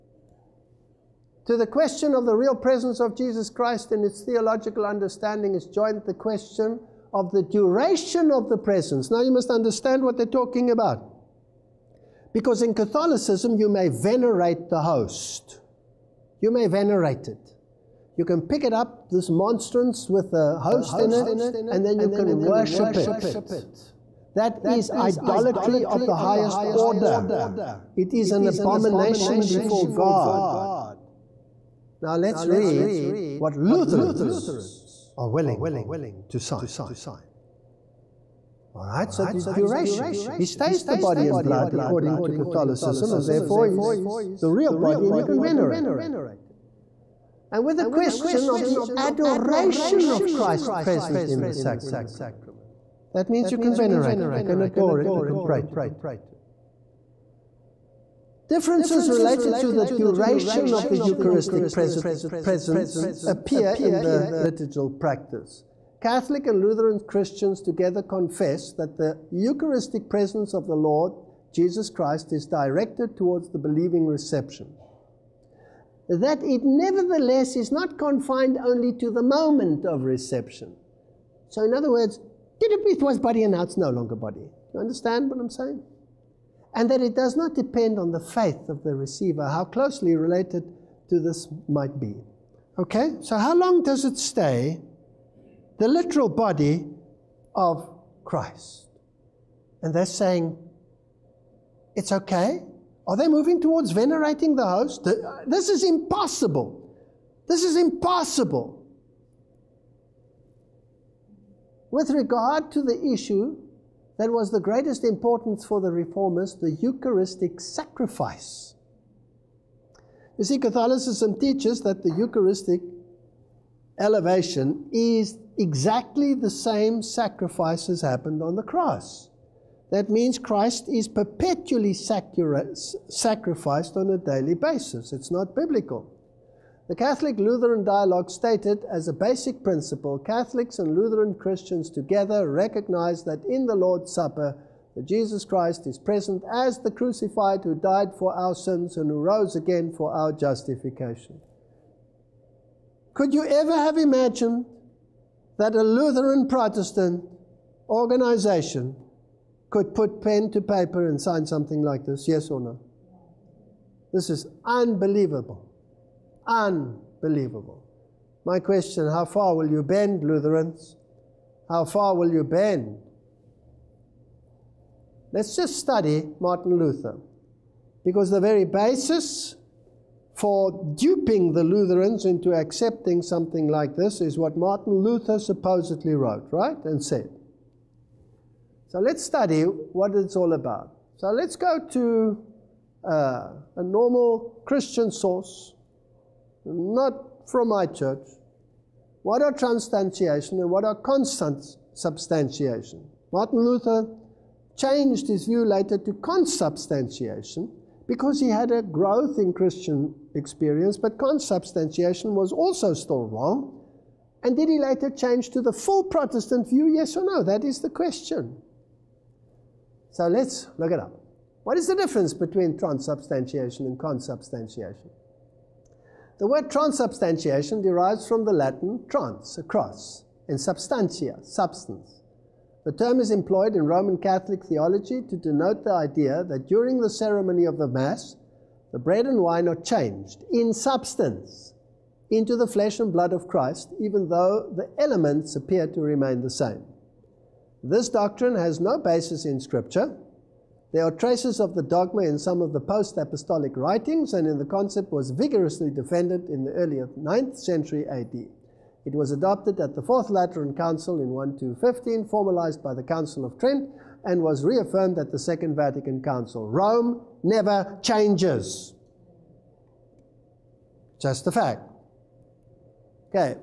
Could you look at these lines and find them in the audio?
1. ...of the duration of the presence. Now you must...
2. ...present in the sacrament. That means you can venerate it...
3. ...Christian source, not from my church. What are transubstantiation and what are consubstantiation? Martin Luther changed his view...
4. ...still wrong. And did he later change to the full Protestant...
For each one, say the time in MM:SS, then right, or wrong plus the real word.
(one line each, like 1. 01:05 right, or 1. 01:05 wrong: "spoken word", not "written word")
1. 00:07 right
2. 00:50 right
3. 03:14 right
4. 03:32 right.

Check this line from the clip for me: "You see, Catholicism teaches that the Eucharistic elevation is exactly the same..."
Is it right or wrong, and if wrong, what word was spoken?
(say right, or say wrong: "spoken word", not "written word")
right.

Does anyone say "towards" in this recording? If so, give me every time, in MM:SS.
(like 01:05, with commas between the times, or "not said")
01:13, 01:43.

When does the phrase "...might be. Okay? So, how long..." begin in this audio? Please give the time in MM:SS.
01:31.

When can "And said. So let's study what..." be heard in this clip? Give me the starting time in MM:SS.
03:06.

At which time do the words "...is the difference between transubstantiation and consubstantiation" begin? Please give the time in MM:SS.
03:41.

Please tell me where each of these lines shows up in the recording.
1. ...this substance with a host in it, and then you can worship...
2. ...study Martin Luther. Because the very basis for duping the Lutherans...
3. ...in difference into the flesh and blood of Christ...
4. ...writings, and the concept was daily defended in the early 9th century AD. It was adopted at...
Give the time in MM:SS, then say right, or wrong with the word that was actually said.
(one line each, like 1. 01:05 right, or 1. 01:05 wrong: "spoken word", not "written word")
1. 00:19 wrong: "monstrance", not "substance"
2. 02:55 right
3. 04:00 wrong: "substance", not "difference"
4. 04:13 wrong: "vigorously", not "daily".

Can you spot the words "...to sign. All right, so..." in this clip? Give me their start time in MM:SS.
00:36.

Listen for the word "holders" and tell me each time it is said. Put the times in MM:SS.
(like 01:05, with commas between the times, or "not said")
not said.